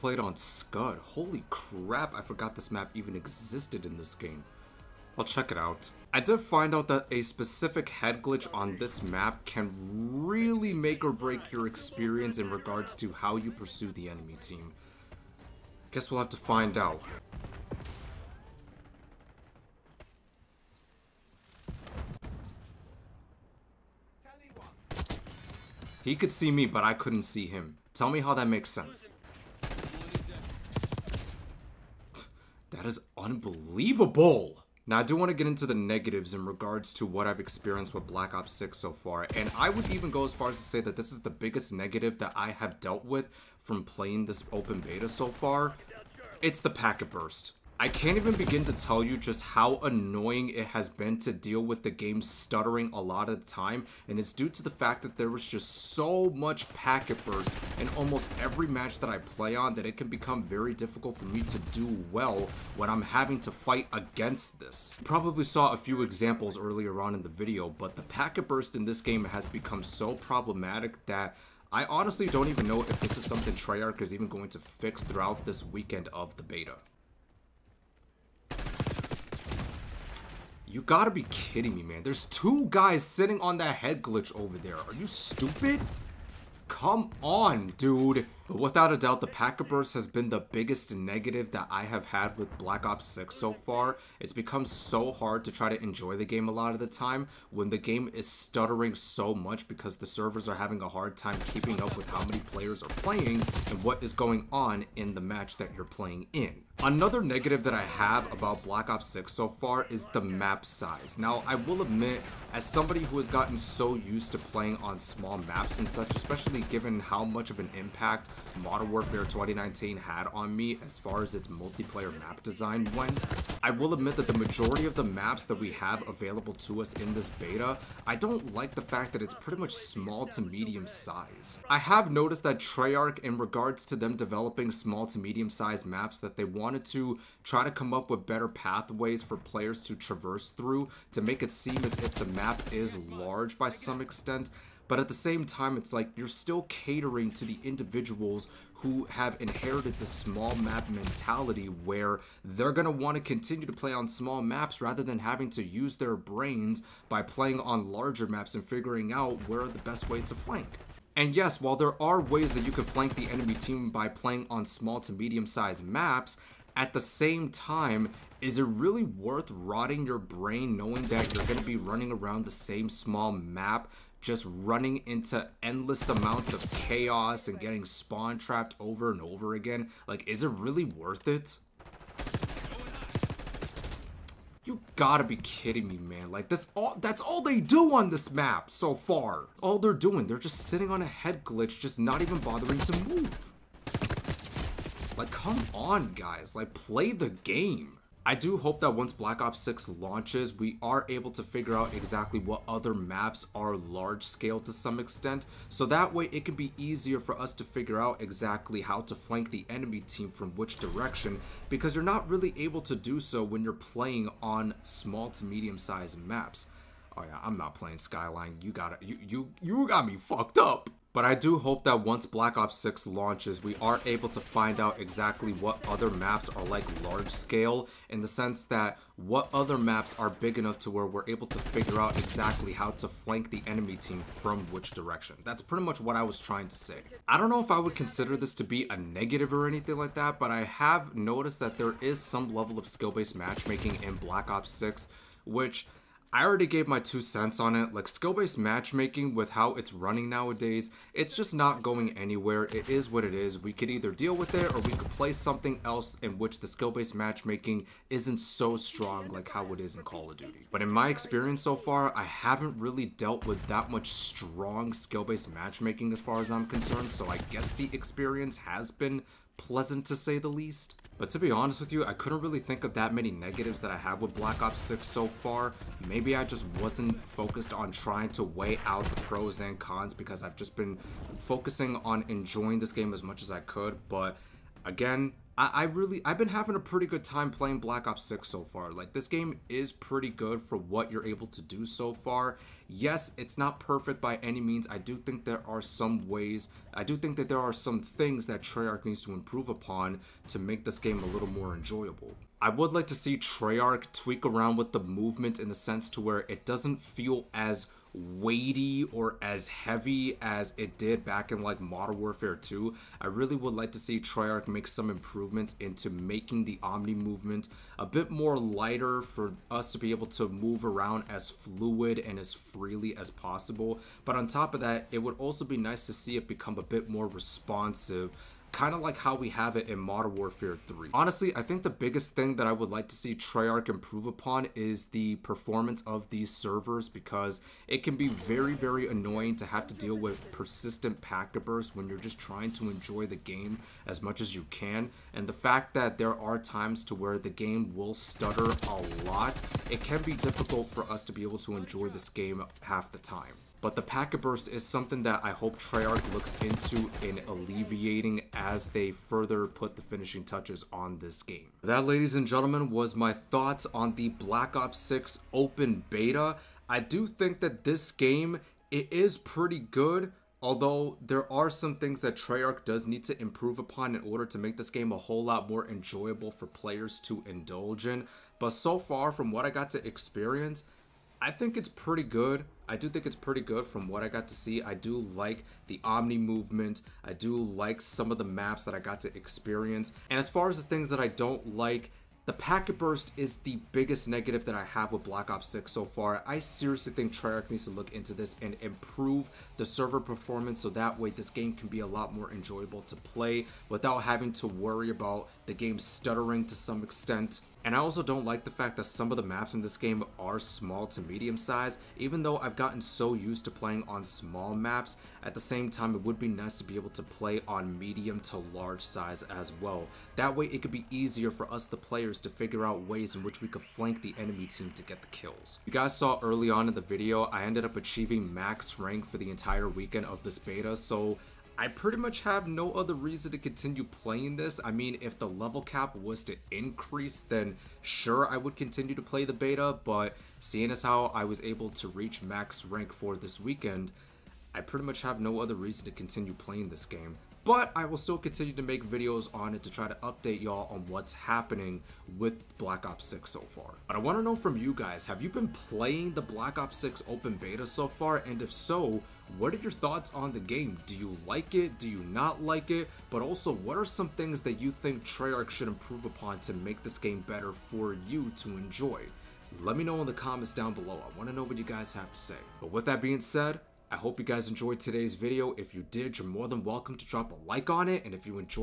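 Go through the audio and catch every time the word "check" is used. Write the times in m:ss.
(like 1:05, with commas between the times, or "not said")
0:05.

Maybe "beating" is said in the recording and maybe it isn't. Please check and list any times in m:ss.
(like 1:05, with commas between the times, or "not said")
not said.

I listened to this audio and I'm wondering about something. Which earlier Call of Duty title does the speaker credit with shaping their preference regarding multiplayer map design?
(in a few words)
Modern Warfare 2019.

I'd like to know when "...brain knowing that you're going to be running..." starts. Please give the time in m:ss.
2:50.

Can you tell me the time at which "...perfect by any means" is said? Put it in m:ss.
4:53.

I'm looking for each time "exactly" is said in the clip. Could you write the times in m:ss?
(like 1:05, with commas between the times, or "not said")
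3:21, 3:28, 3:45, 3:52.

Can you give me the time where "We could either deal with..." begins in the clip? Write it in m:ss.
4:13.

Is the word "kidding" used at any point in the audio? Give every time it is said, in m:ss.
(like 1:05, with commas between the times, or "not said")
1:21, 3:05.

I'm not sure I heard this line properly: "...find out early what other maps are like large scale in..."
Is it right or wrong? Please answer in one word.
wrong.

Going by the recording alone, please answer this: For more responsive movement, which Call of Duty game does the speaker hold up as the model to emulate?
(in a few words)
Modern Warfare 3.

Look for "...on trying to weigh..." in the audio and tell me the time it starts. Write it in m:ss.
4:37.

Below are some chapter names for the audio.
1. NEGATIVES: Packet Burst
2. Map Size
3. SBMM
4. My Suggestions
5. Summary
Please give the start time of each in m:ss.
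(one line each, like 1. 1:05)
1. 0:33
2. 1:45
3. 3:55
4. 5:00
5. 6:00.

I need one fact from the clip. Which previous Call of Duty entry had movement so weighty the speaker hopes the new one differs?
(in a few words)
Modern Warfare 2.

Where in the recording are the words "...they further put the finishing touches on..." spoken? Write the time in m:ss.
5:58.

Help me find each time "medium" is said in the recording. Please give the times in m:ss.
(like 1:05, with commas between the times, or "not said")
2:10, 2:15, 2:45, 3:35, 6:51, 6:57.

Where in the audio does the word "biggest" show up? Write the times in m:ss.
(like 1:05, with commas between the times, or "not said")
0:41, 1:30, 5:31, 6:33.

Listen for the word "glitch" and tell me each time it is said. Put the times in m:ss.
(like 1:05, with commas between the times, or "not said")
0:08, 1:24, 3:11.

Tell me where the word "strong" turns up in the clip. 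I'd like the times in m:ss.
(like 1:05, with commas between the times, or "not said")
4:18, 4:24.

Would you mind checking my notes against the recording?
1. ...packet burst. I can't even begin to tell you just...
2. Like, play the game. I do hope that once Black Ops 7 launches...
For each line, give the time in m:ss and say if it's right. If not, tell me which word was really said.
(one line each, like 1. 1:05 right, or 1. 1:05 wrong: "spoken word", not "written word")
1. 0:46 right
2. 3:16 wrong: "6", not "7".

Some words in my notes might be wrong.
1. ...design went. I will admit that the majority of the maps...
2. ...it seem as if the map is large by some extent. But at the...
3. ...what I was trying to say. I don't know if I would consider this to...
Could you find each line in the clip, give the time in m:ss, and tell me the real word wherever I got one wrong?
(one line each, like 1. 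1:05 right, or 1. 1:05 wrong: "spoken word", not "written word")
1. 2:02 right
2. 2:21 right
3. 3:56 right.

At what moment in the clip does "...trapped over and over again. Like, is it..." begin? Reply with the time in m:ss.
2:58.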